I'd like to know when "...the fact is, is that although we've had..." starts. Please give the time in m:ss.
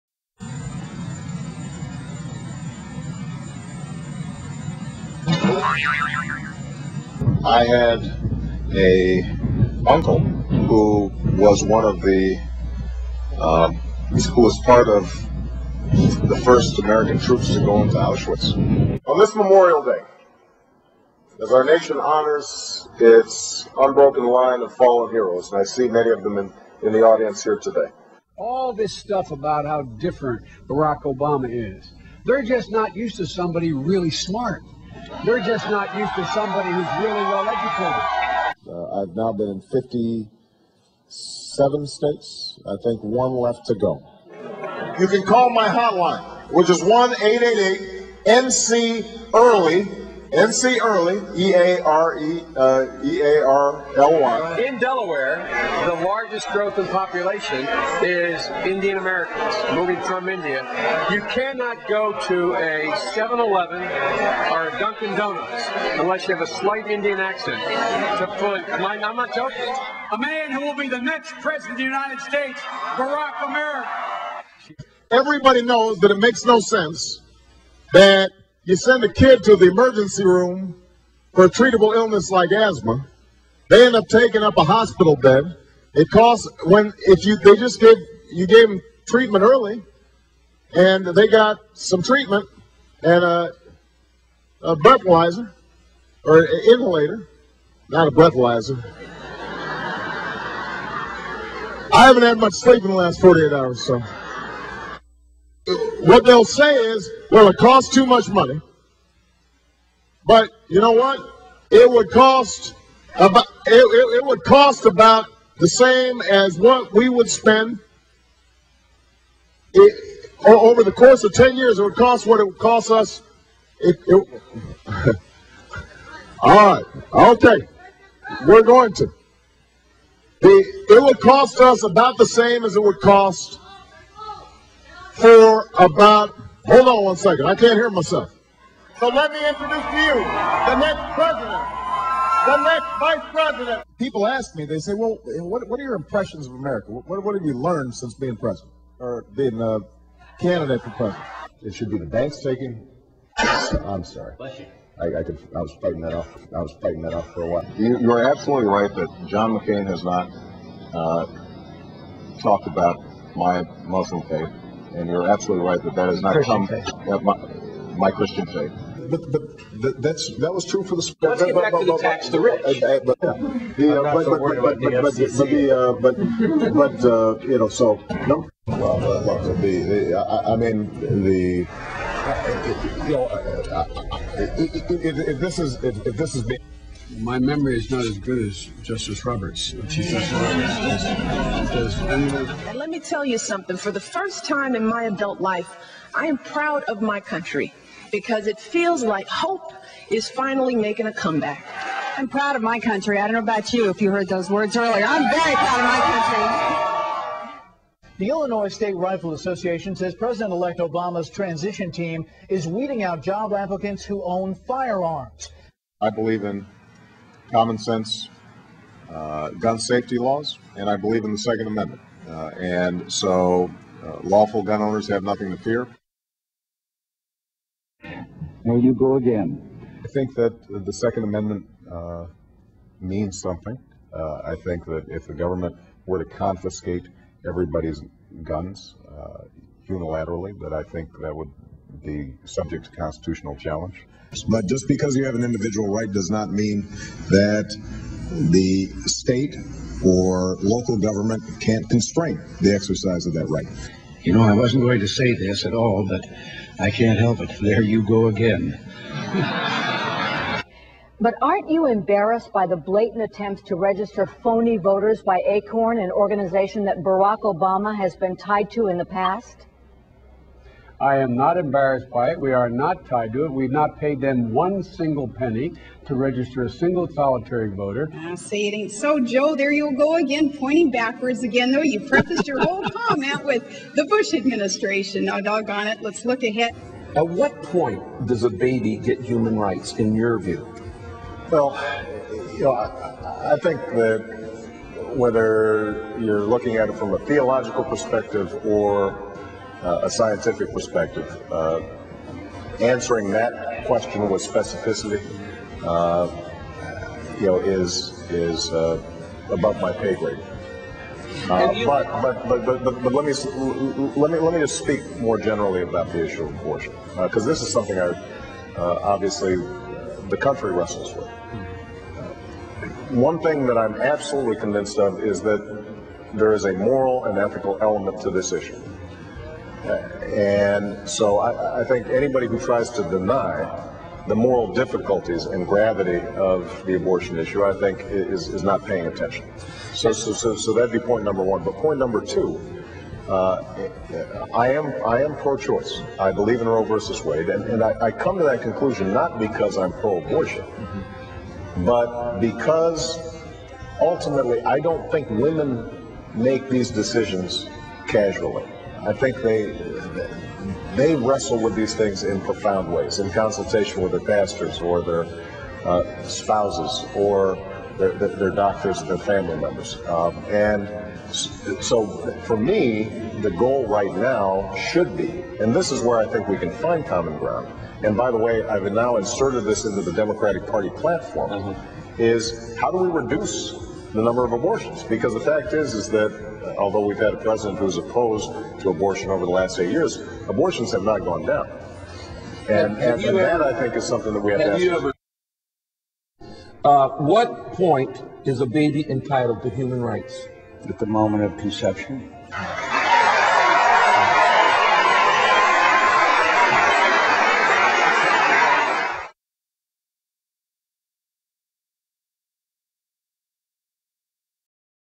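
6:25.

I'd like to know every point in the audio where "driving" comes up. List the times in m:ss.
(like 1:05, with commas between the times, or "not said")
not said.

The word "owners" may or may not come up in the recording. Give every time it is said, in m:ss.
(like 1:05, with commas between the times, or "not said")
3:44.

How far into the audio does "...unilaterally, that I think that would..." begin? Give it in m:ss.
3:59.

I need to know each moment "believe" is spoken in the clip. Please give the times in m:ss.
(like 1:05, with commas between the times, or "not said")
3:36, 3:40, 5:46.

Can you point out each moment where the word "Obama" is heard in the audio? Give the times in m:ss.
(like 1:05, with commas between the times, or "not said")
0:31, 3:30, 4:27.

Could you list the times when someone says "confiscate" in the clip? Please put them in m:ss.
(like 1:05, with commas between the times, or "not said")
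3:56.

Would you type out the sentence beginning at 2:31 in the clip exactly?
It should be the banks taking.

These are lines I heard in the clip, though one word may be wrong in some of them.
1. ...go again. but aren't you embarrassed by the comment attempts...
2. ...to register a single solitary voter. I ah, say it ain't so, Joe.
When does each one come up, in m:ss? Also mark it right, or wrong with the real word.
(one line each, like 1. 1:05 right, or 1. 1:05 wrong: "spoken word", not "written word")
1. 4:18 wrong: "blatant", not "comment"
2. 4:36 right.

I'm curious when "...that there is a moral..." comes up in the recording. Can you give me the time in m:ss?
5:25.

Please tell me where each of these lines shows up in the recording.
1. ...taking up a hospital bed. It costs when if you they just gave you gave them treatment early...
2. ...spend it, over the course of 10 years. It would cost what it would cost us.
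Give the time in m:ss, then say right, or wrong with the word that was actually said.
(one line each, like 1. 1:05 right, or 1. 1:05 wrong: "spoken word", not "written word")
1. 1:24 right
2. 1:57 right.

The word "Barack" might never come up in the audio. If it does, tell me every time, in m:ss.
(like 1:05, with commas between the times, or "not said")
0:30, 1:12, 4:26.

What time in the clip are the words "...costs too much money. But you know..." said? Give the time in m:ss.
1:47.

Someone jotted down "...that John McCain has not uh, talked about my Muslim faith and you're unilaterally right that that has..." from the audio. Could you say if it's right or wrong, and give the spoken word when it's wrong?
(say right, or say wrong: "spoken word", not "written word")
wrong: "absolutely", not "unilaterally".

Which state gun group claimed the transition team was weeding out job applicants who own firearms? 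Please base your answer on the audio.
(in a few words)
Illinois State Rifle Association.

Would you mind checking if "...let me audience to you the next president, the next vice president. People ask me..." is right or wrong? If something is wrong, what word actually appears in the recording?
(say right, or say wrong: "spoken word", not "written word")
wrong: "introduce", not "audience".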